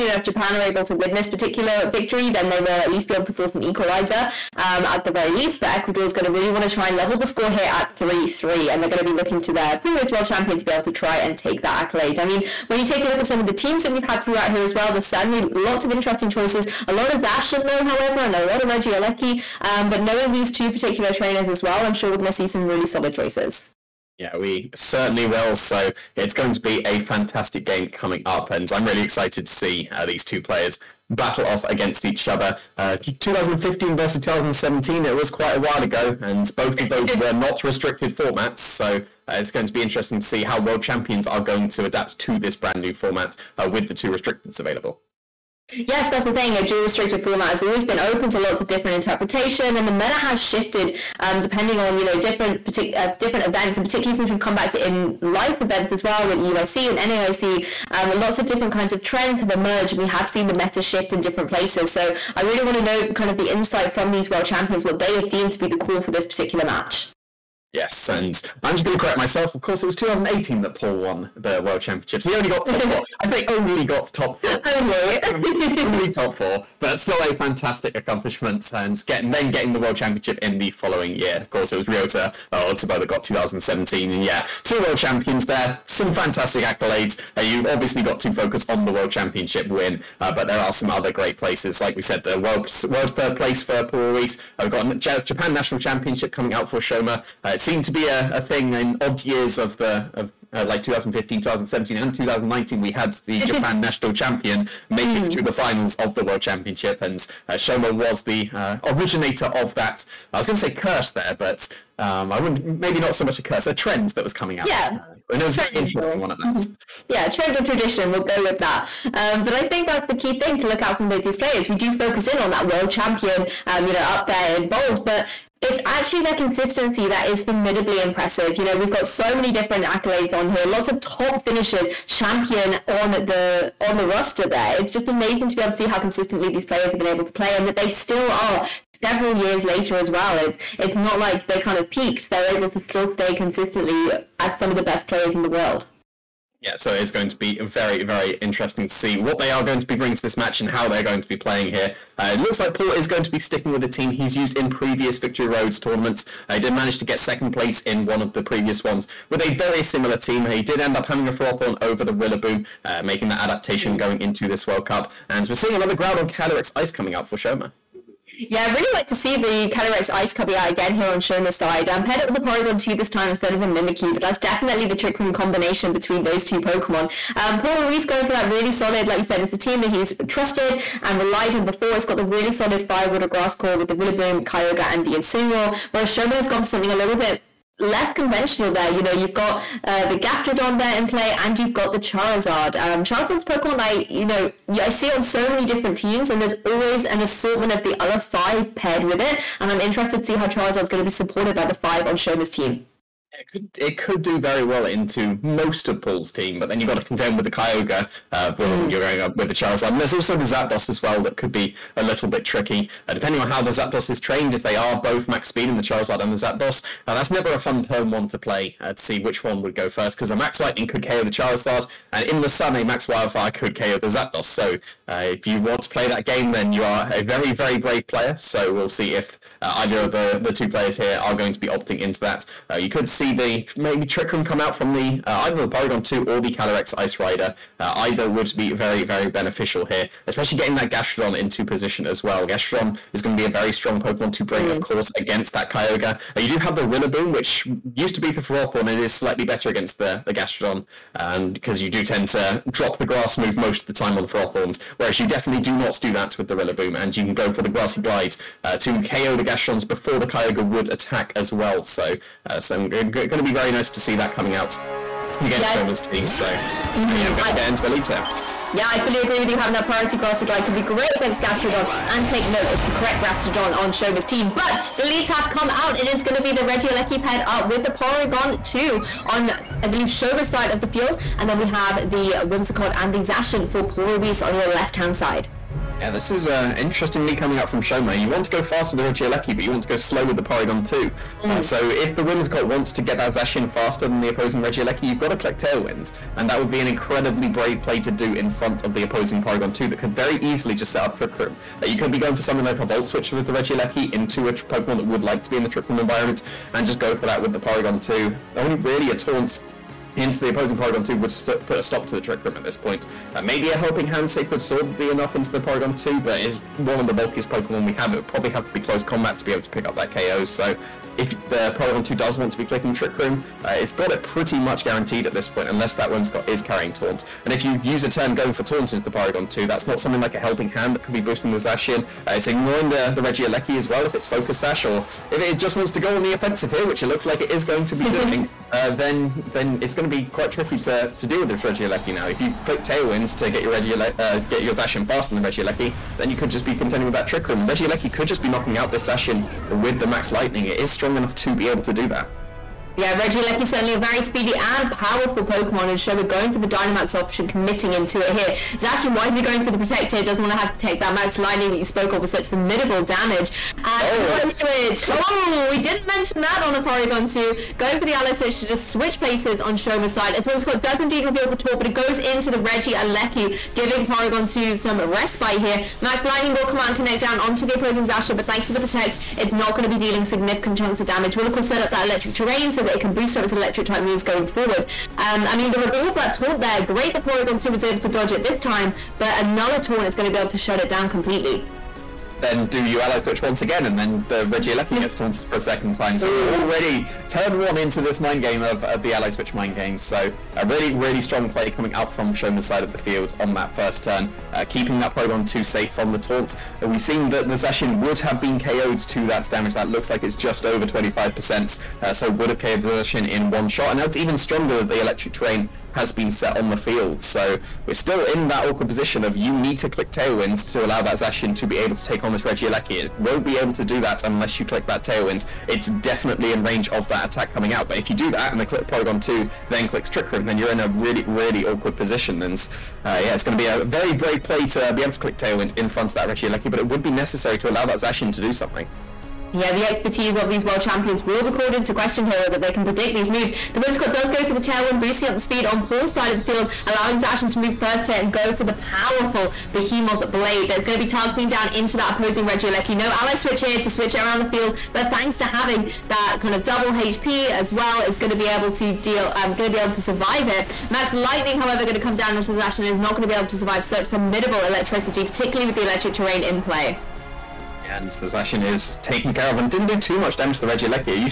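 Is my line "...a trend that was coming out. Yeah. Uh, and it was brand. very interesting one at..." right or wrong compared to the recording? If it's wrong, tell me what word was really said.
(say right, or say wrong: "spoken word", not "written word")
wrong: "trend", not "brand".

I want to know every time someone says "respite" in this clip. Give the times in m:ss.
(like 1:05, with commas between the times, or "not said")
6:15.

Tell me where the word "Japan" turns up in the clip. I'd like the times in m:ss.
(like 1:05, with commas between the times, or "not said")
0:00, 1:35, 1:43.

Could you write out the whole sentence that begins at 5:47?
Regieleki could just be knocking out this Zacian with the Max Lightning.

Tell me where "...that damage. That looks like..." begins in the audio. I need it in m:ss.
6:49.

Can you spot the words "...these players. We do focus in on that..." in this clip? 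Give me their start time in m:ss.
2:01.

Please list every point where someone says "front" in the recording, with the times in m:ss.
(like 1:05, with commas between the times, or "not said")
4:58, 7:15.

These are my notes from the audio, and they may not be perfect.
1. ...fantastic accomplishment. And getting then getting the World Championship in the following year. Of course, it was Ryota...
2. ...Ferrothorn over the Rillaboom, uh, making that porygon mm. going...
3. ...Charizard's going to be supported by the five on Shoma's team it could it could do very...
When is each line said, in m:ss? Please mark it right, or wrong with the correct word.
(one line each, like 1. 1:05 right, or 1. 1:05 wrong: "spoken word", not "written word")
1. 1:17 right
2. 2:41 wrong: "adaptation", not "porygon"
3. 3:20 right.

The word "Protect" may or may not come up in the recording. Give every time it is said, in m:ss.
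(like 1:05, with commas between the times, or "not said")
5:59, 6:18.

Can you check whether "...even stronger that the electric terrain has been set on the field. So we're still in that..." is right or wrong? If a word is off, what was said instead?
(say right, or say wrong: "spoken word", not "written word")
right.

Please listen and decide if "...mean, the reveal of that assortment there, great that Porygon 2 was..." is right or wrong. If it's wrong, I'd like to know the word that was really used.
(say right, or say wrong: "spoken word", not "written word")
wrong: "taunt", not "assortment".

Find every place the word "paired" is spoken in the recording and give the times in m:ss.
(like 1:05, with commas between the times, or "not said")
2:52, 3:18, 4:37.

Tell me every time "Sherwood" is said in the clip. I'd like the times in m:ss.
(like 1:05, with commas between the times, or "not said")
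5:55.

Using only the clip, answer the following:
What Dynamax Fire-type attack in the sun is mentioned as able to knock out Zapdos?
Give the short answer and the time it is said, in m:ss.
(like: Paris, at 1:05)
Max Wildfire, at 3:42.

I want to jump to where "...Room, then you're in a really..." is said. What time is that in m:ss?
7:10.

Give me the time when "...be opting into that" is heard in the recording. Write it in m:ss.
3:51.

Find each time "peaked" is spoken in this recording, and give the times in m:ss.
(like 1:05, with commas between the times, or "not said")
2:21.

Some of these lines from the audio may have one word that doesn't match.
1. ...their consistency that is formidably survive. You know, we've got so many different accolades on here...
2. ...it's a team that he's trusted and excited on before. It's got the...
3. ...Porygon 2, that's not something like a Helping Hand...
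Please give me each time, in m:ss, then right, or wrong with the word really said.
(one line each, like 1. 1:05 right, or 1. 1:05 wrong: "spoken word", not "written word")
1. 2:06 wrong: "impressive", not "survive"
2. 2:59 wrong: "relied", not "excited"
3. 5:29 right.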